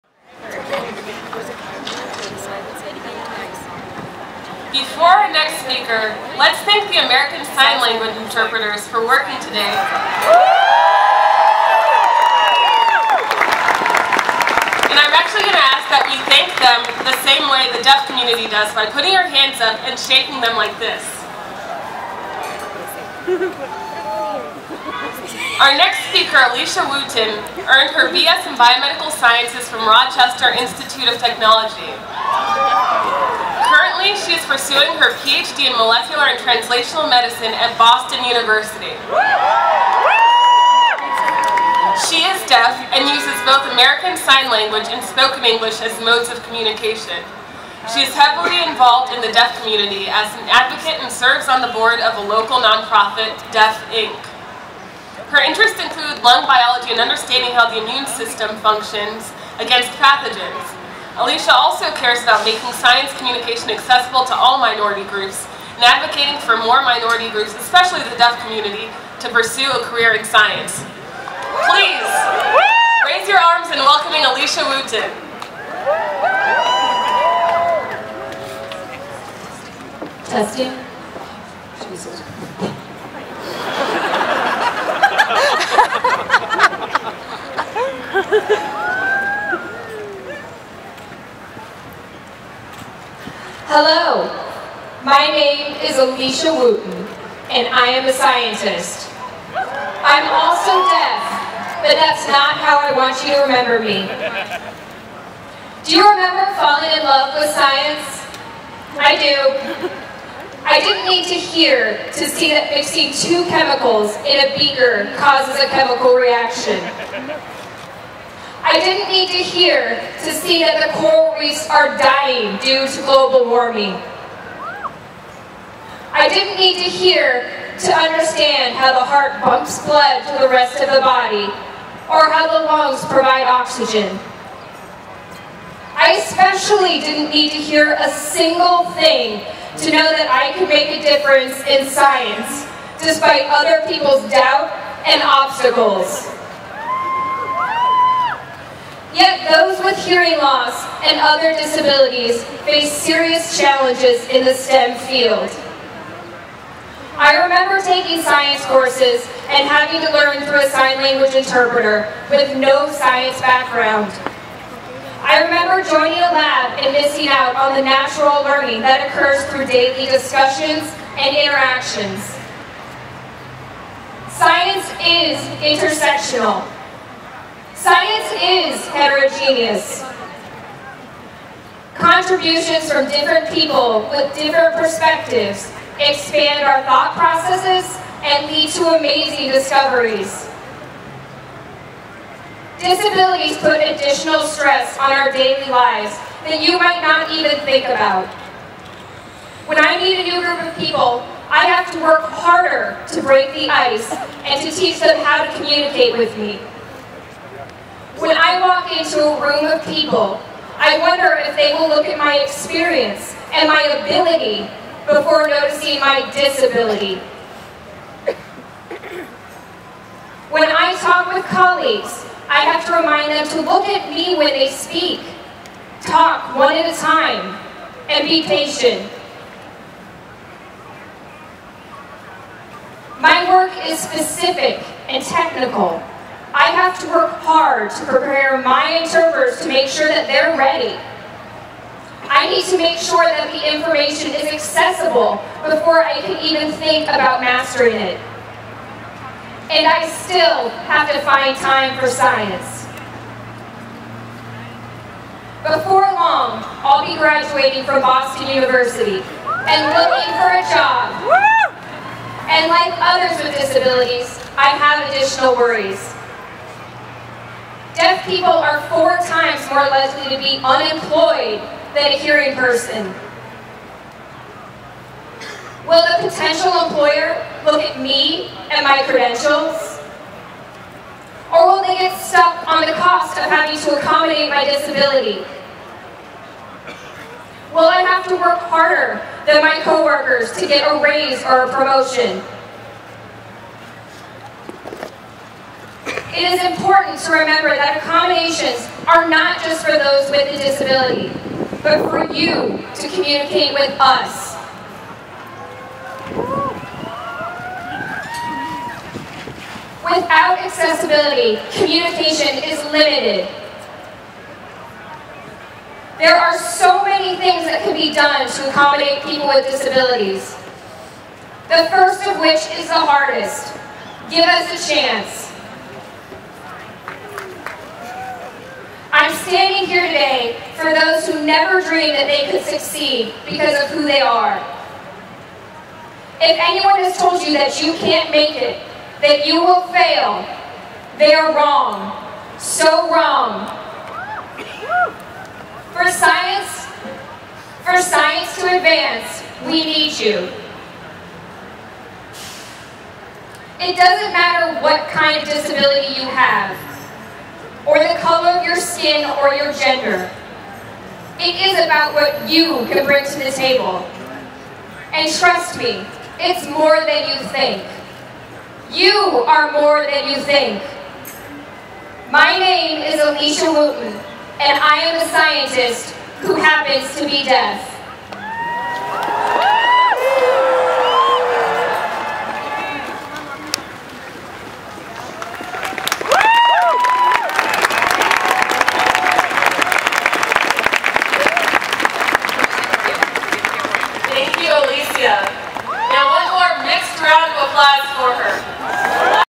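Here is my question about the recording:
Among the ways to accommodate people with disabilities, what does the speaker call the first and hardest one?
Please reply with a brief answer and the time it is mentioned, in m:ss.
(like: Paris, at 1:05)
Give us a chance, at 5:24.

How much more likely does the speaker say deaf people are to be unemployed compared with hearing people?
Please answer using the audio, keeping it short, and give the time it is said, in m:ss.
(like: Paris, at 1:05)
4 times, at 4:28.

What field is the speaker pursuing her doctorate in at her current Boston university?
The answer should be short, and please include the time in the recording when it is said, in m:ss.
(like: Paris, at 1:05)
Molecular and translational medicine, at 0:35.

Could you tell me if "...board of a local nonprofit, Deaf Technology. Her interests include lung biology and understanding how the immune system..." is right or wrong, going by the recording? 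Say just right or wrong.
wrong.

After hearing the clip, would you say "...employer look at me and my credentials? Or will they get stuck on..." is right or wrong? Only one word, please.
right.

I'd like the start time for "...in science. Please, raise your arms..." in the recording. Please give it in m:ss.
1:10.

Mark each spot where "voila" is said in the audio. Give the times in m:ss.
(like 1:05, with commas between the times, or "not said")
not said.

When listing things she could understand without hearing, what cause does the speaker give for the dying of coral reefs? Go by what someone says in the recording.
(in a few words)
Global warming.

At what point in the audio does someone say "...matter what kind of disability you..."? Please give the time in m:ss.
5:54.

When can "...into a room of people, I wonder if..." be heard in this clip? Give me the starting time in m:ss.
3:28.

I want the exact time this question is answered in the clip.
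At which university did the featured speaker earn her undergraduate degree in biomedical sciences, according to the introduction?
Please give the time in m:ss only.
0:29.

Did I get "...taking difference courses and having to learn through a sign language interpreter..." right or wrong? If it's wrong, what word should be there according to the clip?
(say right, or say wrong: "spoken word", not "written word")
wrong: "science", not "difference".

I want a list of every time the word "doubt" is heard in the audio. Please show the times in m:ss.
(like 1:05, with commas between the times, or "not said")
2:24.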